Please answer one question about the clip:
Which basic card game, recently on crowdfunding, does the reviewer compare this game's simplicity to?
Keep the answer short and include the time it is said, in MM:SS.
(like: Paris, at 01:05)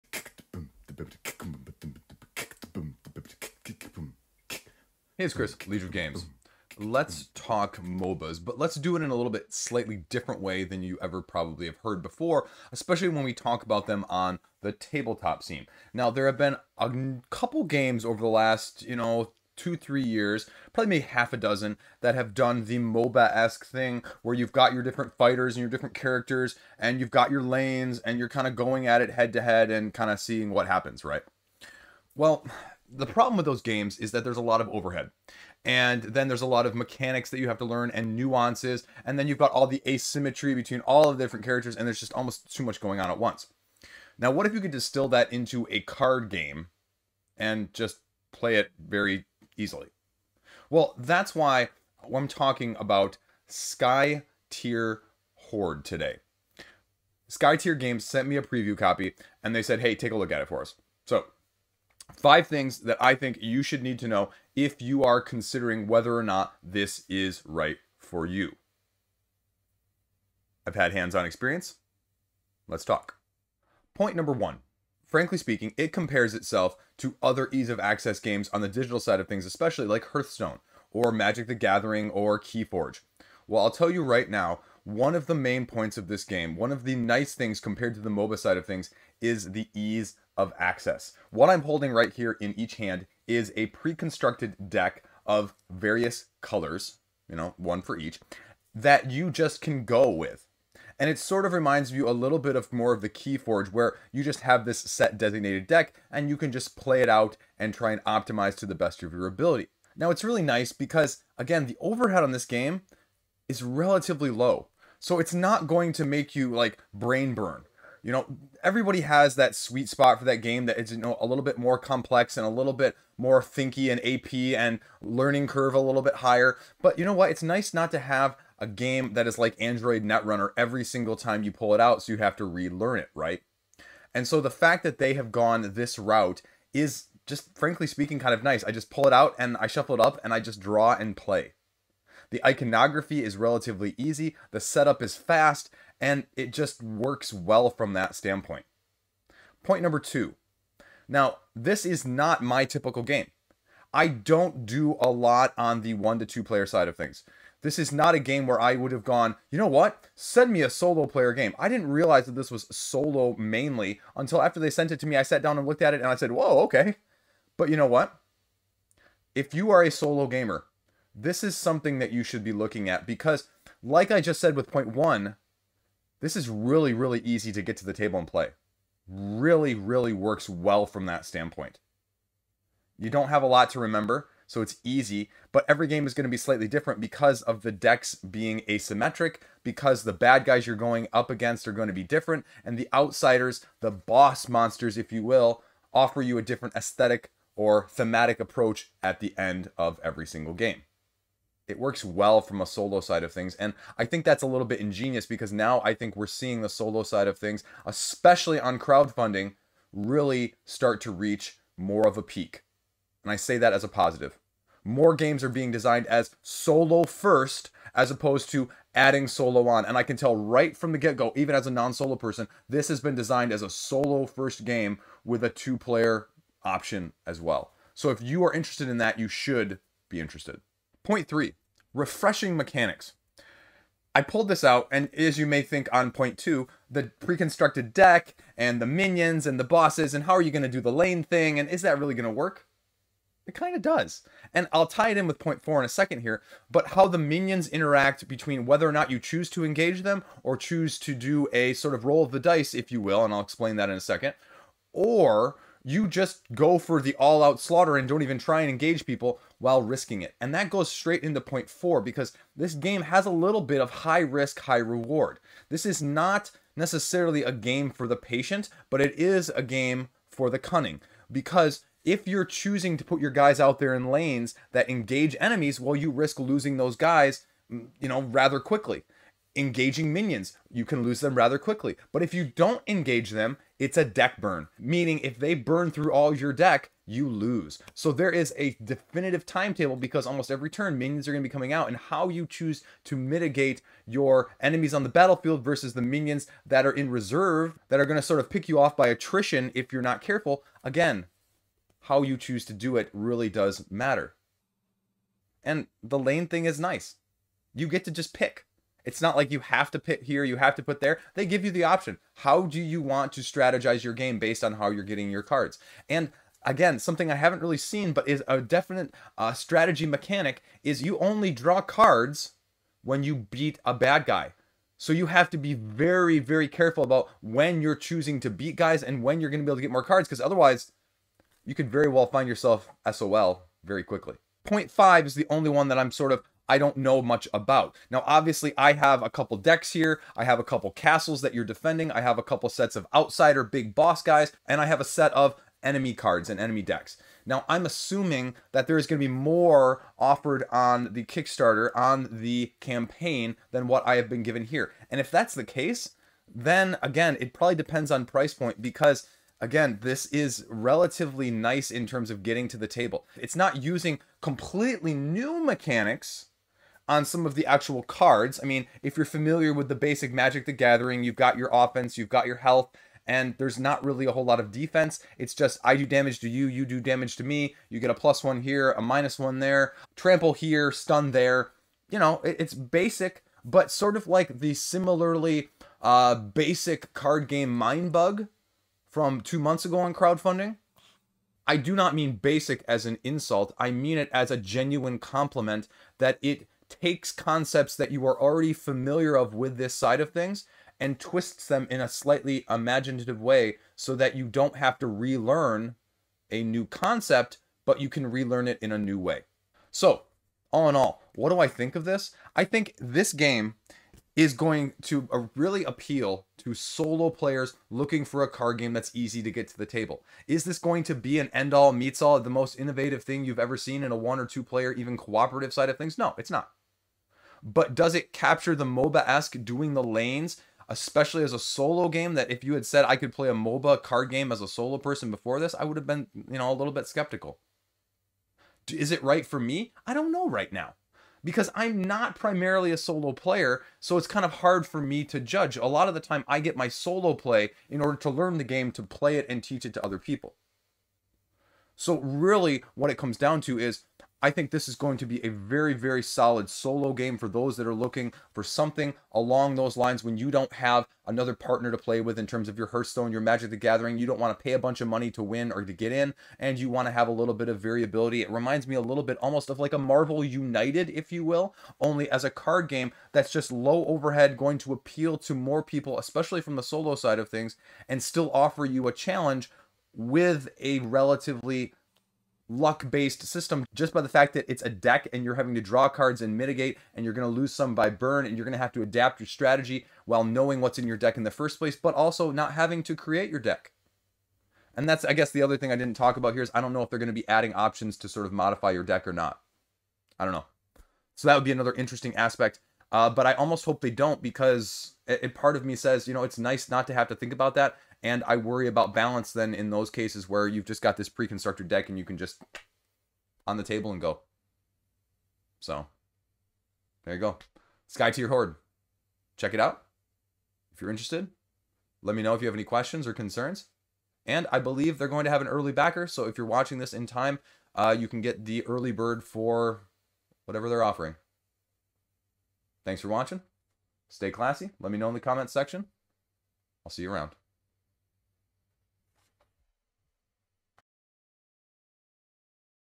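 Mindbug, at 06:27.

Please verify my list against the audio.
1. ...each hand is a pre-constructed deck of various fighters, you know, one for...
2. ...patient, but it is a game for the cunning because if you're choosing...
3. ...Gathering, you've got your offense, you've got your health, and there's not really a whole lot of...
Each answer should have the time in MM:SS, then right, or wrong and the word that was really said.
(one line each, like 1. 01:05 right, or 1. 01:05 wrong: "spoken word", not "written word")
1. 01:32 wrong: "colors", not "fighters"
2. 04:28 right
3. 06:10 right.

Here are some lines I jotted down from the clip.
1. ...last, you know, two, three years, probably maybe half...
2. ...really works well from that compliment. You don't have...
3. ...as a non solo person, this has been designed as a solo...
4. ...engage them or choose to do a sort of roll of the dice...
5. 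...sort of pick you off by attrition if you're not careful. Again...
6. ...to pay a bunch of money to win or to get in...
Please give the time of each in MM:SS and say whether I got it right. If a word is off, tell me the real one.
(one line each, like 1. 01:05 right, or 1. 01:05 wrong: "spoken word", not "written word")
1. 00:18 right
2. 02:59 wrong: "standpoint", not "compliment"
3. 03:41 right
4. 04:09 right
5. 04:58 right
6. 07:44 right.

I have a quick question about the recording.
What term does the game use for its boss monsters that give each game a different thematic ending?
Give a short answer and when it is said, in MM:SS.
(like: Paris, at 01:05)
outsiders, at 03:12.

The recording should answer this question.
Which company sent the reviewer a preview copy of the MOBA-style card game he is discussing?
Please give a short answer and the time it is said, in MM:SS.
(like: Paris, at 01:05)
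Sky Tier Games, at 00:57.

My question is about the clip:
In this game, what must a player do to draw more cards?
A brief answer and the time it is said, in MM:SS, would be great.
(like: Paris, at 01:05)
beat a bad guy, at 05:23.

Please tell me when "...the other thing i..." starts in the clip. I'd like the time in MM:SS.
08:15.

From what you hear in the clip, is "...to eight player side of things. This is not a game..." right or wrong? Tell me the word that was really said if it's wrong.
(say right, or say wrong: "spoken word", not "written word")
wrong: "two", not "eight".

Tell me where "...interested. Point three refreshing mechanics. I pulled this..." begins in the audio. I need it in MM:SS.
03:50.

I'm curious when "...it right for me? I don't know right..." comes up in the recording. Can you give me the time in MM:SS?
07:19.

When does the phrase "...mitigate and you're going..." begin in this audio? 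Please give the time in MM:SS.
08:06.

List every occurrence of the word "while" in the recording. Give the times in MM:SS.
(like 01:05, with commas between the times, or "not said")
04:19, 08:10.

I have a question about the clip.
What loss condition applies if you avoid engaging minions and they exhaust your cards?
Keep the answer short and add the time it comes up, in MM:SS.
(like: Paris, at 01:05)
deck burn, at 04:44.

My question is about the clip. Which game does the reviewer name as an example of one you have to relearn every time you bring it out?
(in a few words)
Android Netrunner.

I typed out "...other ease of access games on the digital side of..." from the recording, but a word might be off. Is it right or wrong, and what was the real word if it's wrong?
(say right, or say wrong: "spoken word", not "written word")
right.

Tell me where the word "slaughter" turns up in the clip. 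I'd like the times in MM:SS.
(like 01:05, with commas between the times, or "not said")
04:17.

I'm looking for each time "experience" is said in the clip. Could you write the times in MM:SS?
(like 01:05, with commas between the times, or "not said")
01:11.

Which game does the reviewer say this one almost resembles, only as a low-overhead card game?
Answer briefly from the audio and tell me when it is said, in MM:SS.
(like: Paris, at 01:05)
Marvel United, at 07:49.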